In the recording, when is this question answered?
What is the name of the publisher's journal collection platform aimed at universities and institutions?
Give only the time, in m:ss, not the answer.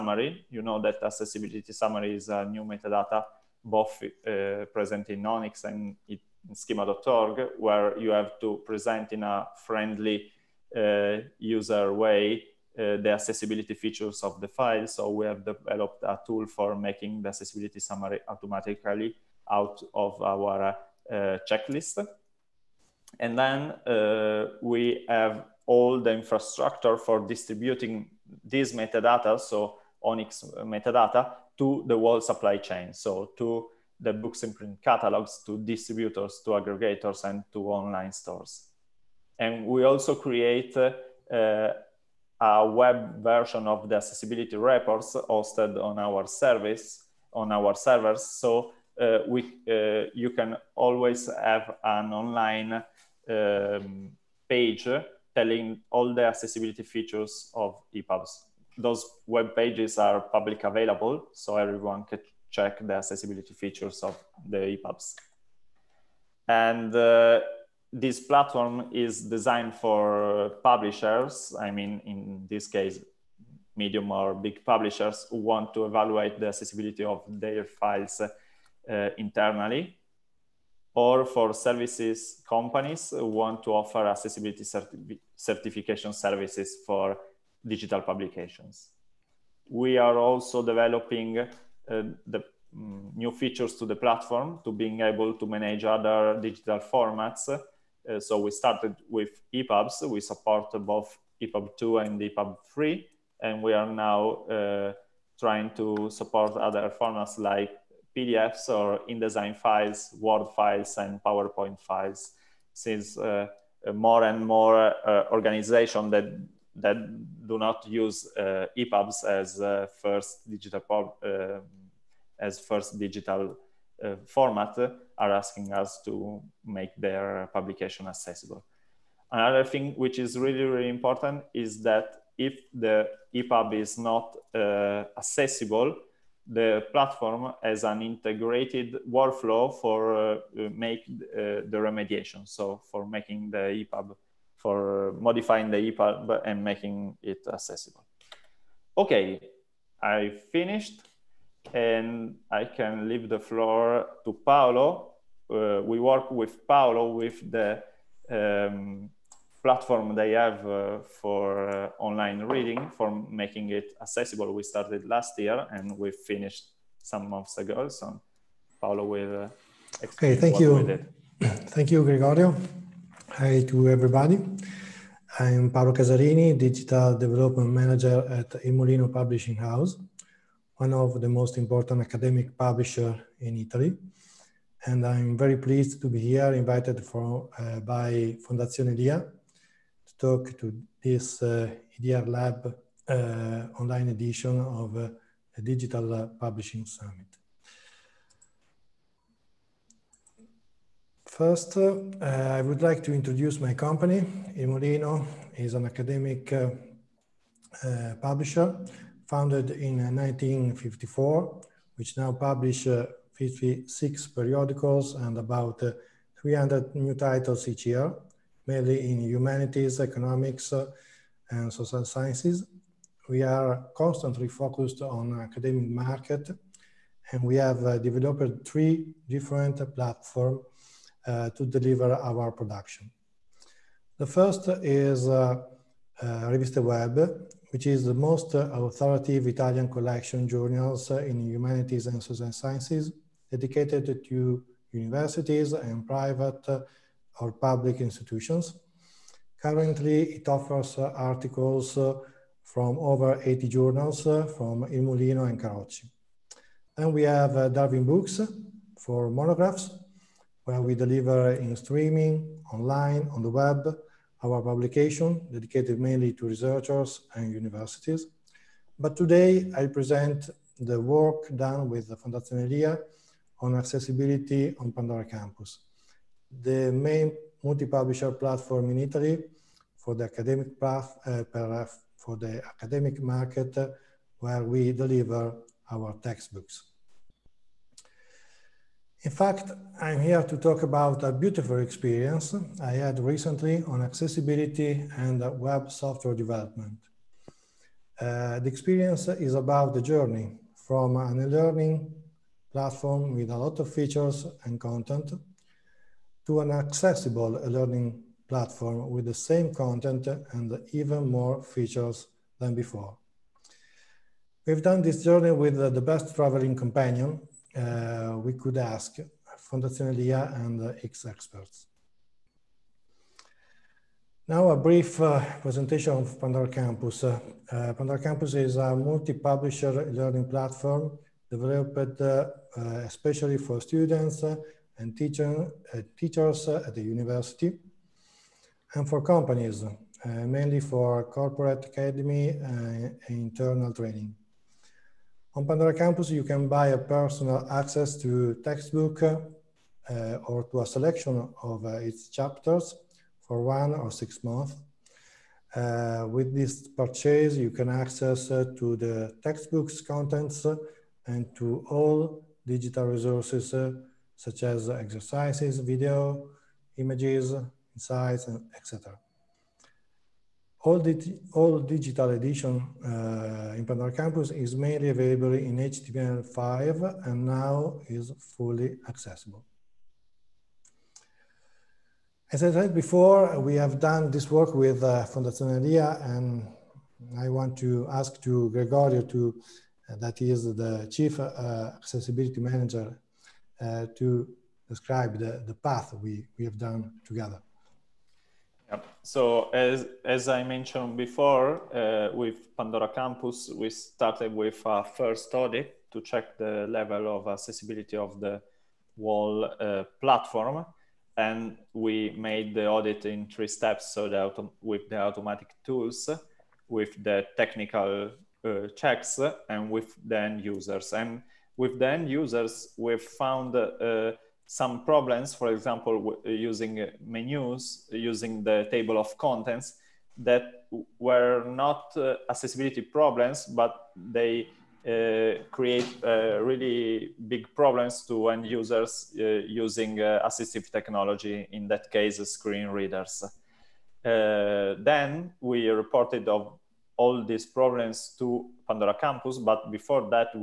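3:56.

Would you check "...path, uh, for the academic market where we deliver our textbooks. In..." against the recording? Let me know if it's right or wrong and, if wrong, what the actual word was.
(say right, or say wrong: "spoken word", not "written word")
right.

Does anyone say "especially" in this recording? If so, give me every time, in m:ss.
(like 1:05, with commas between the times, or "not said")
5:33.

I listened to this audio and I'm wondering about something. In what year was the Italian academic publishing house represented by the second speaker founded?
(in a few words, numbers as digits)
1954.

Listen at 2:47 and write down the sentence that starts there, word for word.
So Paolo will uh, explain okay, thank you.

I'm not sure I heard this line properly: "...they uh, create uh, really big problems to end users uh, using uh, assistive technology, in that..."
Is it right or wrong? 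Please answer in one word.
right.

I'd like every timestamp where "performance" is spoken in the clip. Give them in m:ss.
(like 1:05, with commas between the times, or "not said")
not said.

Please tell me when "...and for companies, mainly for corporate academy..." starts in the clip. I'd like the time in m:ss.
5:38.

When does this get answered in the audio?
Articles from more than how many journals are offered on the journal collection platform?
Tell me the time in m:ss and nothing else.
4:12.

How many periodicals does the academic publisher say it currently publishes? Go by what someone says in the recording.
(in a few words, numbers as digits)
56.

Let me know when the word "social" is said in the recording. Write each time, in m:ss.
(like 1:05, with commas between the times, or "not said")
3:41, 4:02.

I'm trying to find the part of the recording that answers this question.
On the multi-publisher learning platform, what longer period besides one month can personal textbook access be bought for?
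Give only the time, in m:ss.
5:54.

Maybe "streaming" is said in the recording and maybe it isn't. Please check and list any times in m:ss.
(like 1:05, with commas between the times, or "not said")
4:21.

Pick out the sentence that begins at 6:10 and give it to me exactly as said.
All, all digital edition uh, in Pandora Campus is mainly available in HTML5 and now is fully accessible.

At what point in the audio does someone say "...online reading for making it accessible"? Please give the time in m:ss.
2:41.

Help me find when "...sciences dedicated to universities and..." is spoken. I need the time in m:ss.
4:02.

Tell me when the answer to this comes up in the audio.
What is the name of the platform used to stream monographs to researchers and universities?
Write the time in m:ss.
4:17.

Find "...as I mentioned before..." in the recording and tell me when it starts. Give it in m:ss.
6:40.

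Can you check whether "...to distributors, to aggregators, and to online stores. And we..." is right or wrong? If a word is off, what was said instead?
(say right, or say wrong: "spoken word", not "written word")
right.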